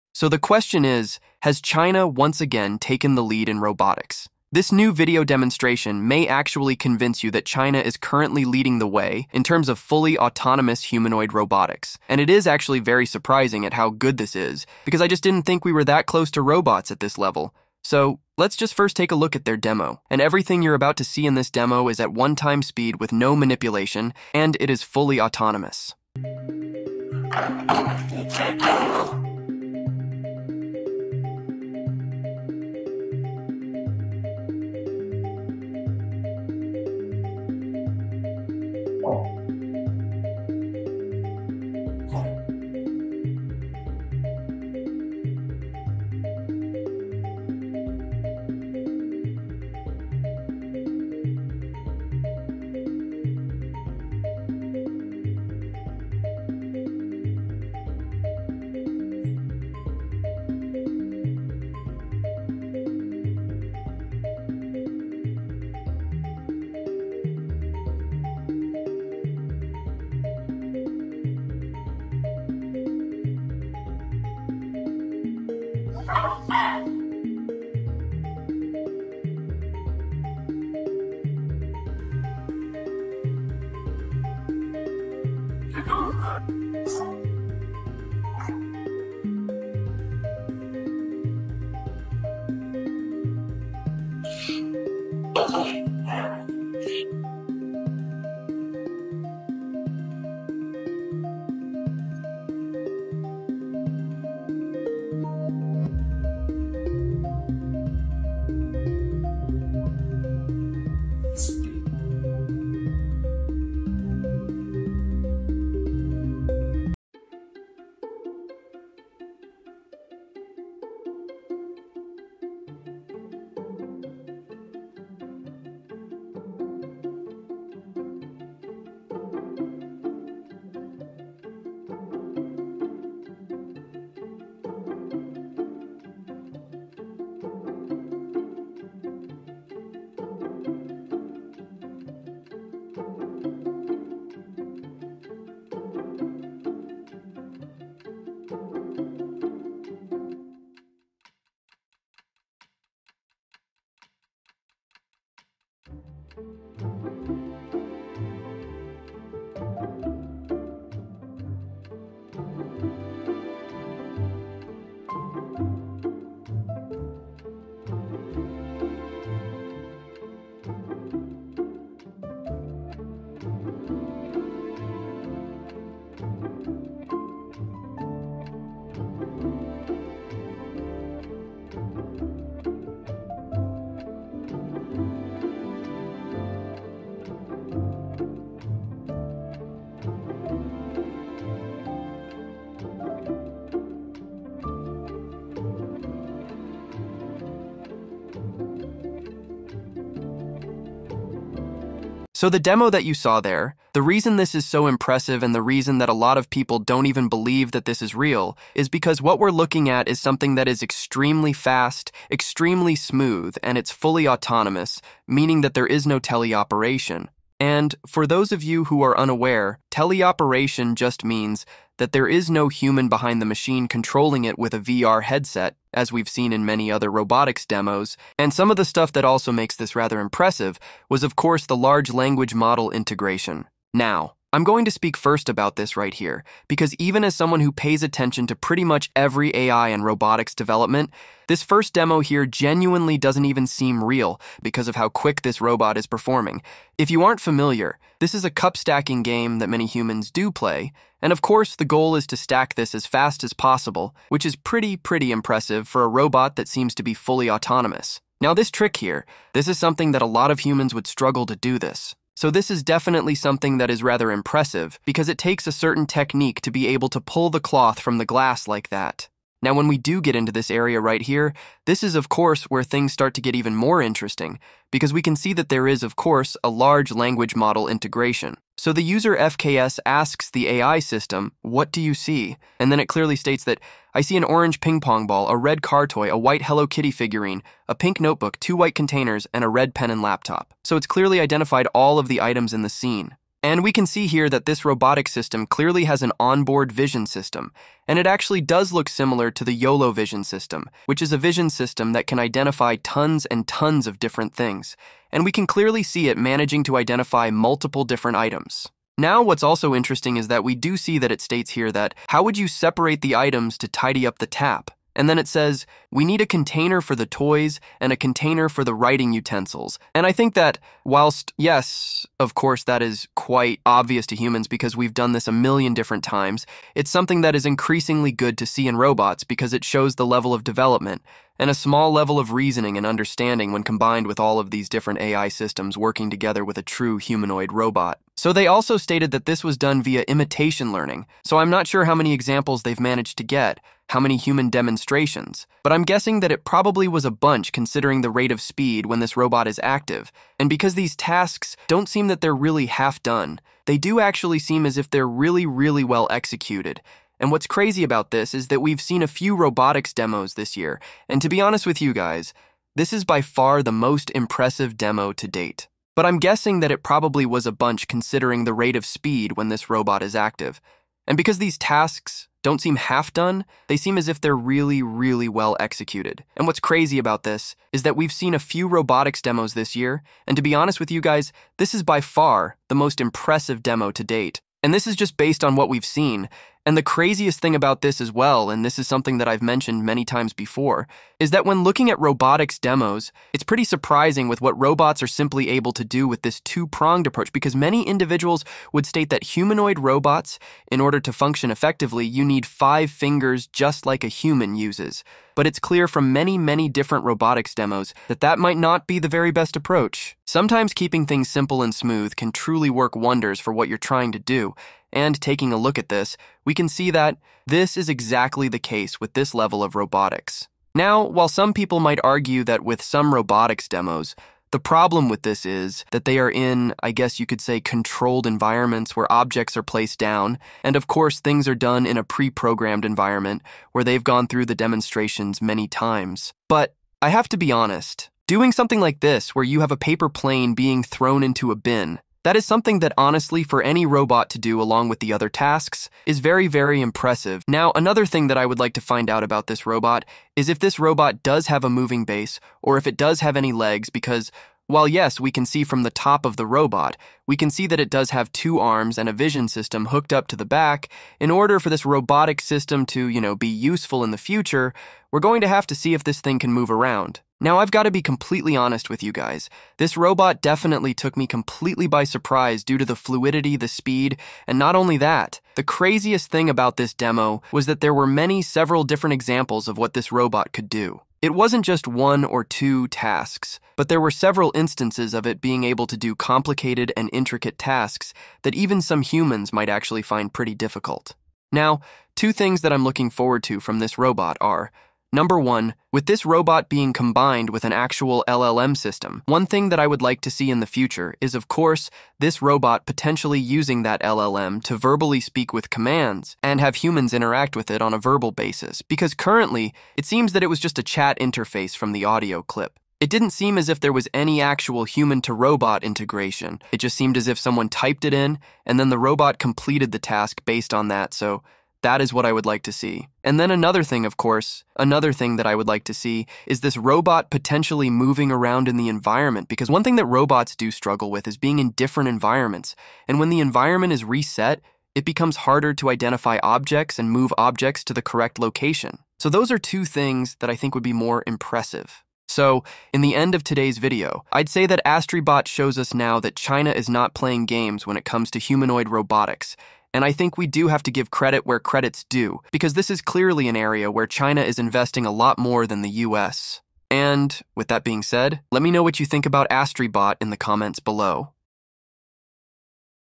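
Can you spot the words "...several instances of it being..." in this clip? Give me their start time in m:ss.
8:04.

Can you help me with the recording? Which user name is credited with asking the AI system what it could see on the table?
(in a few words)
FKS.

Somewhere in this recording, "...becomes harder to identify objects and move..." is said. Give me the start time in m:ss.
8:55.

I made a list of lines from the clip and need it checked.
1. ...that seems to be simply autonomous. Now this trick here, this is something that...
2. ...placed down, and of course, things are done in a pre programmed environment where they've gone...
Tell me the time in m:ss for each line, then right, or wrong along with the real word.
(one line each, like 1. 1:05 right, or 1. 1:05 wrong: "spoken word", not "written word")
1. 4:16 wrong: "fully", not "simply"
2. 7:09 right.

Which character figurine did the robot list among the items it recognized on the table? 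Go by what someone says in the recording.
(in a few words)
Hello Kitty.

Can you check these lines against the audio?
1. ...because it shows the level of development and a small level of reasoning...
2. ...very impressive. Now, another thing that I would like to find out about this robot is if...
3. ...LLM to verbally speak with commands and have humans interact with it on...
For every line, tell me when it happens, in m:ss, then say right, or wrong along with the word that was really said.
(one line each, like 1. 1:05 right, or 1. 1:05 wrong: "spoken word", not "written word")
1. 5:29 right
2. 7:26 right
3. 8:24 right.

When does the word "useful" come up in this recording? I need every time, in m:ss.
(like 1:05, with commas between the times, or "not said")
7:43.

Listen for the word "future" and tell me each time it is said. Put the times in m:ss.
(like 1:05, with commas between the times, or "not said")
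7:44, 8:20.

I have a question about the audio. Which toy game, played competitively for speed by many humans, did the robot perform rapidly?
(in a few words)
cup stacking.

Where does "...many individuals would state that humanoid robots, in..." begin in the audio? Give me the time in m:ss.
6:37.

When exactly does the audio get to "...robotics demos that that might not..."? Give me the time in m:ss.
6:47.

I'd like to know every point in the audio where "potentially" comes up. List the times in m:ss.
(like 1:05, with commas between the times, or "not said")
8:23, 8:47.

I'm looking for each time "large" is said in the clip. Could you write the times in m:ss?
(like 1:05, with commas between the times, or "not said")
3:51, 4:36.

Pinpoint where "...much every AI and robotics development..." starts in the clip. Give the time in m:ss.
3:58.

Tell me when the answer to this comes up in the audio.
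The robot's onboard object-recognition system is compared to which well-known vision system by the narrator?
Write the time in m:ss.
4:59.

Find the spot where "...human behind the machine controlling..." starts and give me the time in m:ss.
3:42.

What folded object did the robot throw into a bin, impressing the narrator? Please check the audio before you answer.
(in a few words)
a paper plane.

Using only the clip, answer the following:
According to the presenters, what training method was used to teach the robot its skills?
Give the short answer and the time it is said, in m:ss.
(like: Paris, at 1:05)
imitation learning, at 5:40.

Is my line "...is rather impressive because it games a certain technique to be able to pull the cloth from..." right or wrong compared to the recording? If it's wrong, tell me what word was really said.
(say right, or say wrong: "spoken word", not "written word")
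wrong: "takes", not "games".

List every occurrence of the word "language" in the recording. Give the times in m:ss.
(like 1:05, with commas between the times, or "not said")
3:52, 4:37.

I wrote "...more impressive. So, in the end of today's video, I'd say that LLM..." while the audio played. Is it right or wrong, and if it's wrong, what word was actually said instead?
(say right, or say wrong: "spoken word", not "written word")
wrong: "AstriBot", not "LLM".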